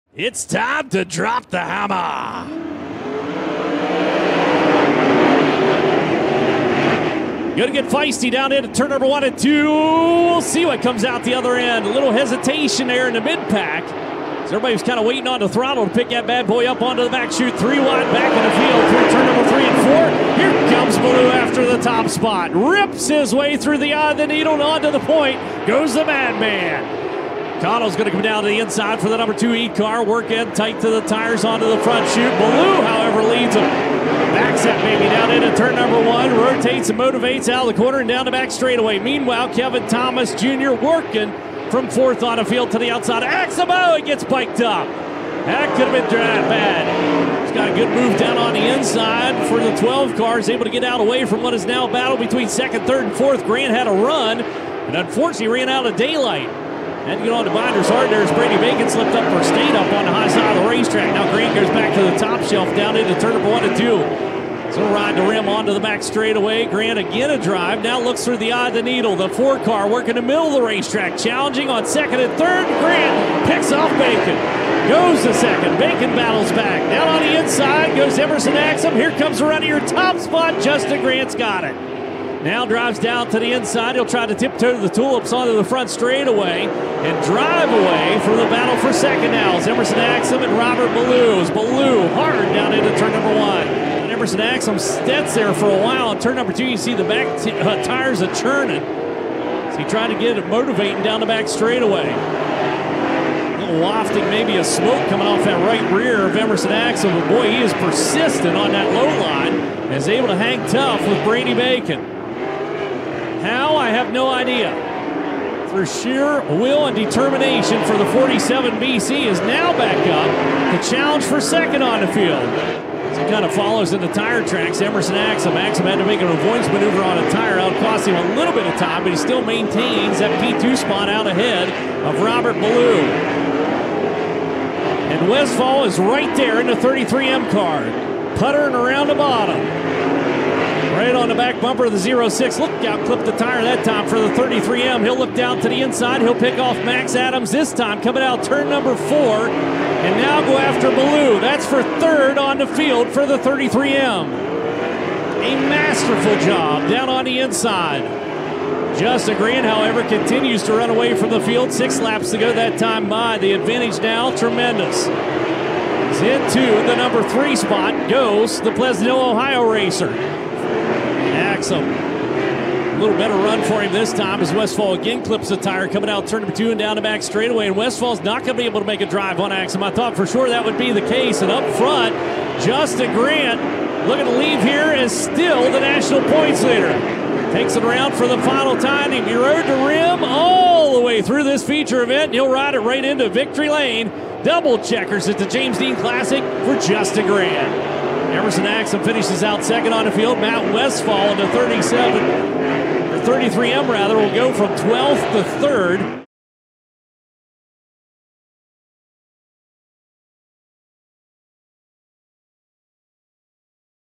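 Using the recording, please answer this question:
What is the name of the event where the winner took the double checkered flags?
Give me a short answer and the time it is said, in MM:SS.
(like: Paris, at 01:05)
James Dean Classic, at 03:15.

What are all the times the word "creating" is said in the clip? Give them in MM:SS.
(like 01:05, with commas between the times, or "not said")
not said.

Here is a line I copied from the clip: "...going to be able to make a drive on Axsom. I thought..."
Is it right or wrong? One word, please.
right.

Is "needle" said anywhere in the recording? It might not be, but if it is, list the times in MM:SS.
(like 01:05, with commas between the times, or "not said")
00:24, 01:08.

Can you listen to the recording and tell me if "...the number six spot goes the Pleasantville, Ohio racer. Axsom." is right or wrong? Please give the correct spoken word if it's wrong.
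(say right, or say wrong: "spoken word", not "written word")
wrong: "three", not "six".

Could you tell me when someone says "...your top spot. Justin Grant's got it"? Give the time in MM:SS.
01:19.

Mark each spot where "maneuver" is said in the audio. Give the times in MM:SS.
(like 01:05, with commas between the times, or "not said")
02:06.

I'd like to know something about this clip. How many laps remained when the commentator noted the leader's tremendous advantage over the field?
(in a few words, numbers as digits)
6.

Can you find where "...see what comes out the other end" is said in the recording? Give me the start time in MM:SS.
00:10.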